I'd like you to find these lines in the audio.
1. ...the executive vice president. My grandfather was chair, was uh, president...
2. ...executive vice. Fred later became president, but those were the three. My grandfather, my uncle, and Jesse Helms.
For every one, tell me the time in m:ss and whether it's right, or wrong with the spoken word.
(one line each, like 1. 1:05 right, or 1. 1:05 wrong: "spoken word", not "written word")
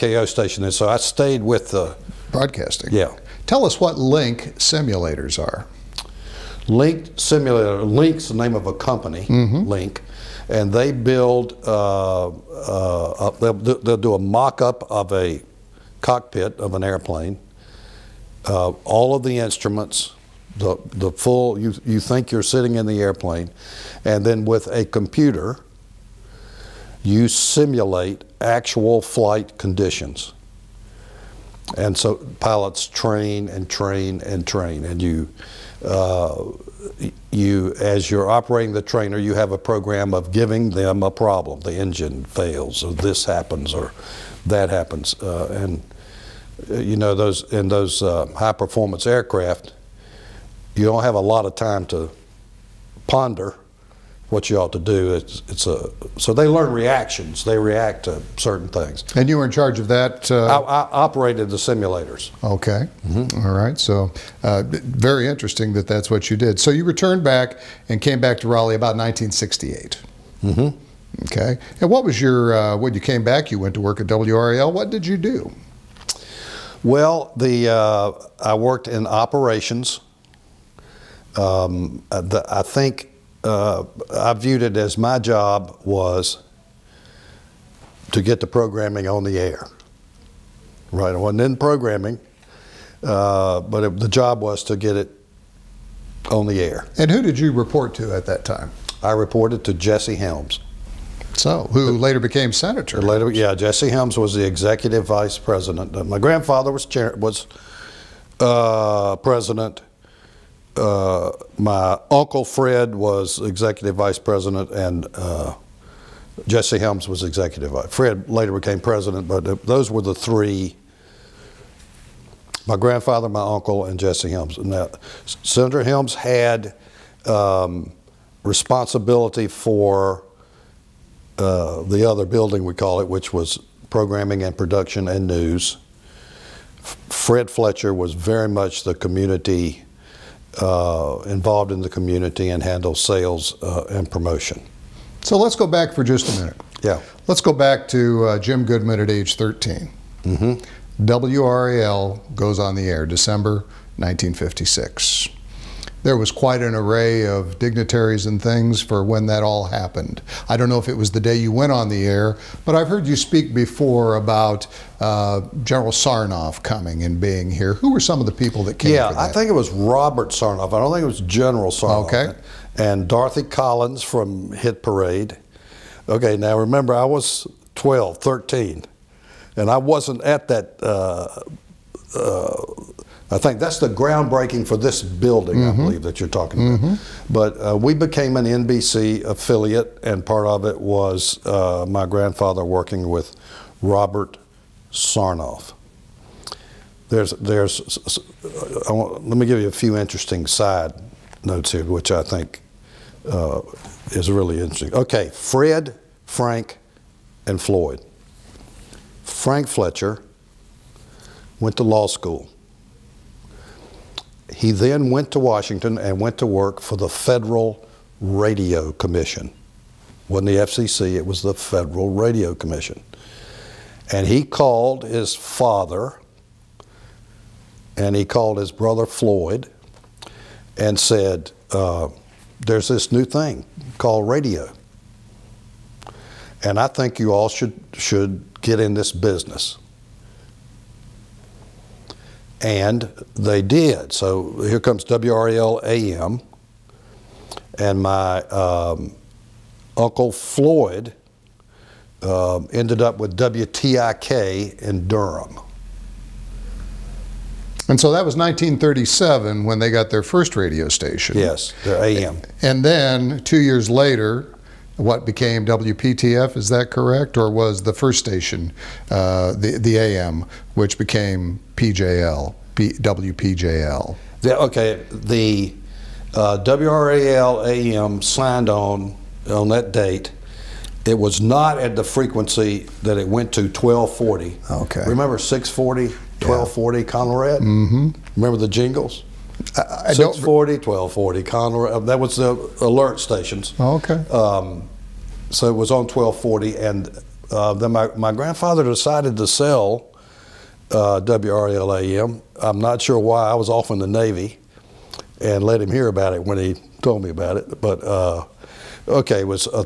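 1. 1:44 right
2. 1:57 right.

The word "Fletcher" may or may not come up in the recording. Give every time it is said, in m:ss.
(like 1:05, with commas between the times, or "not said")
2:17, 3:29.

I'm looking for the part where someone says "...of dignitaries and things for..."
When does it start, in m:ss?
2:37.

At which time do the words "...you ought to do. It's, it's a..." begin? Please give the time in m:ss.
0:54.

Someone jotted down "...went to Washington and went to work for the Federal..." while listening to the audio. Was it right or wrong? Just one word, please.
right.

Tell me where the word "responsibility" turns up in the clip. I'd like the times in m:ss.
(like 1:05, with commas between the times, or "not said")
2:08.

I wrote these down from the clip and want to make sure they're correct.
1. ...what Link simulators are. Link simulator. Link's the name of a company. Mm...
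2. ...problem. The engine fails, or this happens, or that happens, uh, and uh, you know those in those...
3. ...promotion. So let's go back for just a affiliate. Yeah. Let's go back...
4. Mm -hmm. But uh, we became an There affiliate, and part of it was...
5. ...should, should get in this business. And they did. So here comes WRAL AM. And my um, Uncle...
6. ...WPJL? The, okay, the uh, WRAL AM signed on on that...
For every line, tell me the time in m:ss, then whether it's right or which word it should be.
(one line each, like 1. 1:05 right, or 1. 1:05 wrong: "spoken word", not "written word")
1. 0:03 right
2. 0:41 right
3. 2:24 wrong: "minute", not "affiliate"
4. 3:06 wrong: "NBC", not "There"
5. 3:57 right
6. 4:32 right.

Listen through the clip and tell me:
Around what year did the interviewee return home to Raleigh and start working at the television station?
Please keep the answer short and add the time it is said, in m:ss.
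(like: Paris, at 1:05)
1968, at 1:08.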